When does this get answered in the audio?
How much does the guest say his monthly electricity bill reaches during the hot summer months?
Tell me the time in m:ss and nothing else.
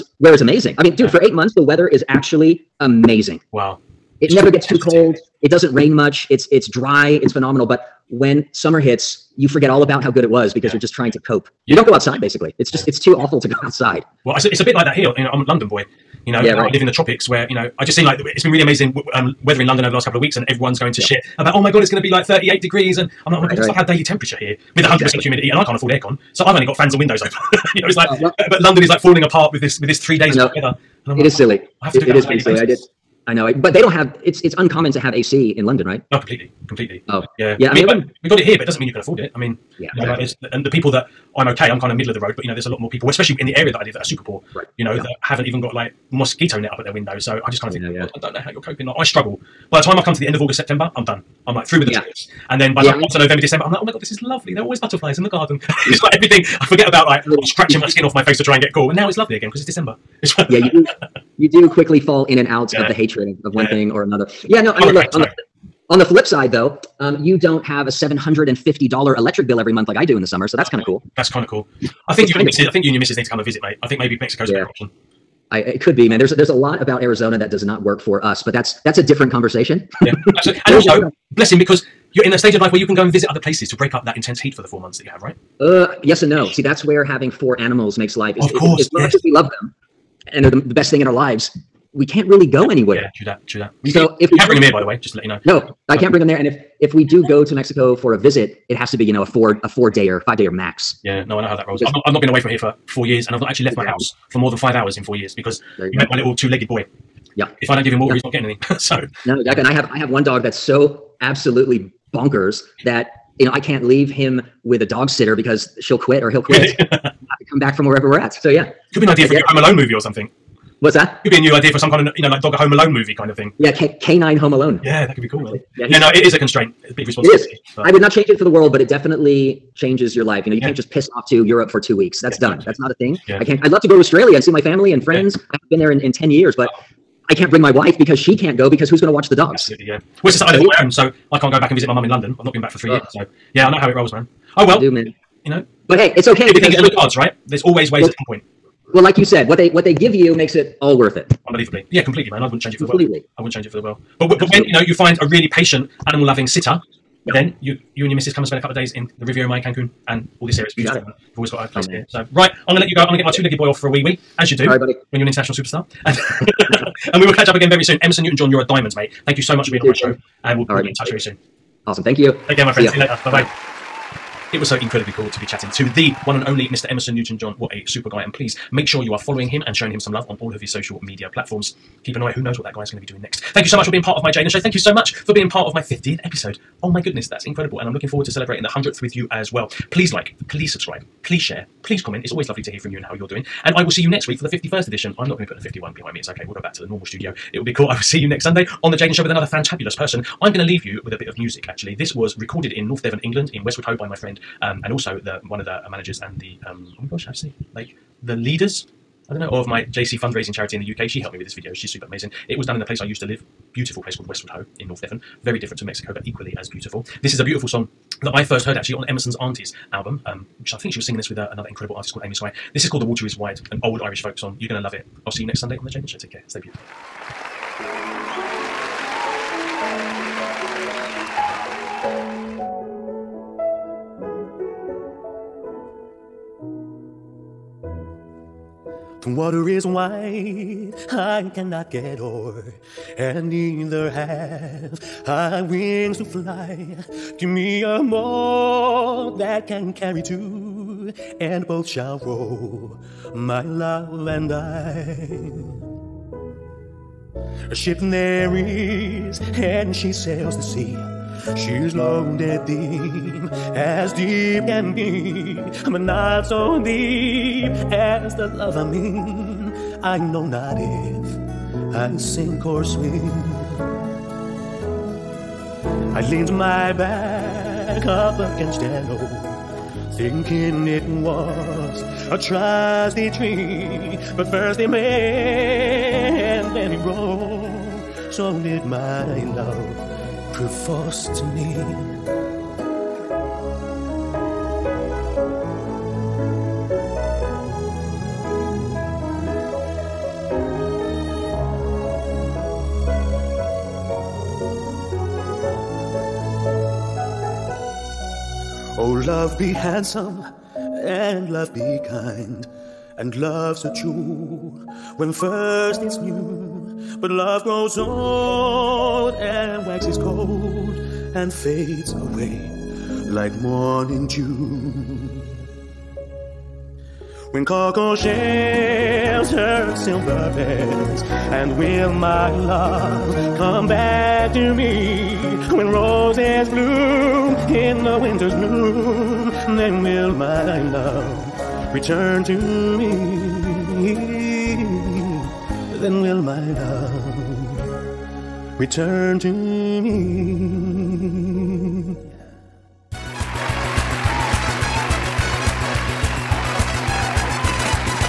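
1:07.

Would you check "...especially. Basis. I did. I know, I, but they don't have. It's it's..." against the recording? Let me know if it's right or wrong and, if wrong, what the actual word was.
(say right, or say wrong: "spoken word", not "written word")
wrong: "silly", not "especially".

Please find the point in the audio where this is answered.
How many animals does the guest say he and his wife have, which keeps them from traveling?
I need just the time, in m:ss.
1:27.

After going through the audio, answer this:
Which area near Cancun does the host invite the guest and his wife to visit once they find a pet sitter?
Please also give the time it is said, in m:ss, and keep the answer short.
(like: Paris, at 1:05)
Riviera Maya, at 2:39.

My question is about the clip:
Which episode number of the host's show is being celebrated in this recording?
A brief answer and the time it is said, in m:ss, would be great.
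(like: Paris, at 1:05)
50th, at 3:05.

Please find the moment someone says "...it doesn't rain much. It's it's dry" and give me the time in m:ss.
0:05.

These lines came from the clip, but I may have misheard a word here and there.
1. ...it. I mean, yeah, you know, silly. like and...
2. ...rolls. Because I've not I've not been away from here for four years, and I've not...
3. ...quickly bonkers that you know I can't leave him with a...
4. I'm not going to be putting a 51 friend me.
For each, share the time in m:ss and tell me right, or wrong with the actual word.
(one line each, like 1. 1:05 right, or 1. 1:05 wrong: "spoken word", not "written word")
1. 0:39 wrong: "exactly", not "silly"
2. 1:41 right
3. 1:51 wrong: "absolutely", not "quickly"
4. 3:15 wrong: "behind", not "friend".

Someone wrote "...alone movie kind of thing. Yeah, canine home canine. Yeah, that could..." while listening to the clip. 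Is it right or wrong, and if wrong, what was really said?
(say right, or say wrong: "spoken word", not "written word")
wrong: "alone", not "canine".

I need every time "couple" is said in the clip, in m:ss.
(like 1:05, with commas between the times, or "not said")
0:20, 2:38.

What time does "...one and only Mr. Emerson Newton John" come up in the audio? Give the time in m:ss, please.
2:56.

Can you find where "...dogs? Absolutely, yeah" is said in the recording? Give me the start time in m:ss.
2:19.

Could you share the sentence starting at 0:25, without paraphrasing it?
humidity, and I can't afford aircon.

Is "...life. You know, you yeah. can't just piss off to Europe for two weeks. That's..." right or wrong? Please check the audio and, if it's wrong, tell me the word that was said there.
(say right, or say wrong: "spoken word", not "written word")
right.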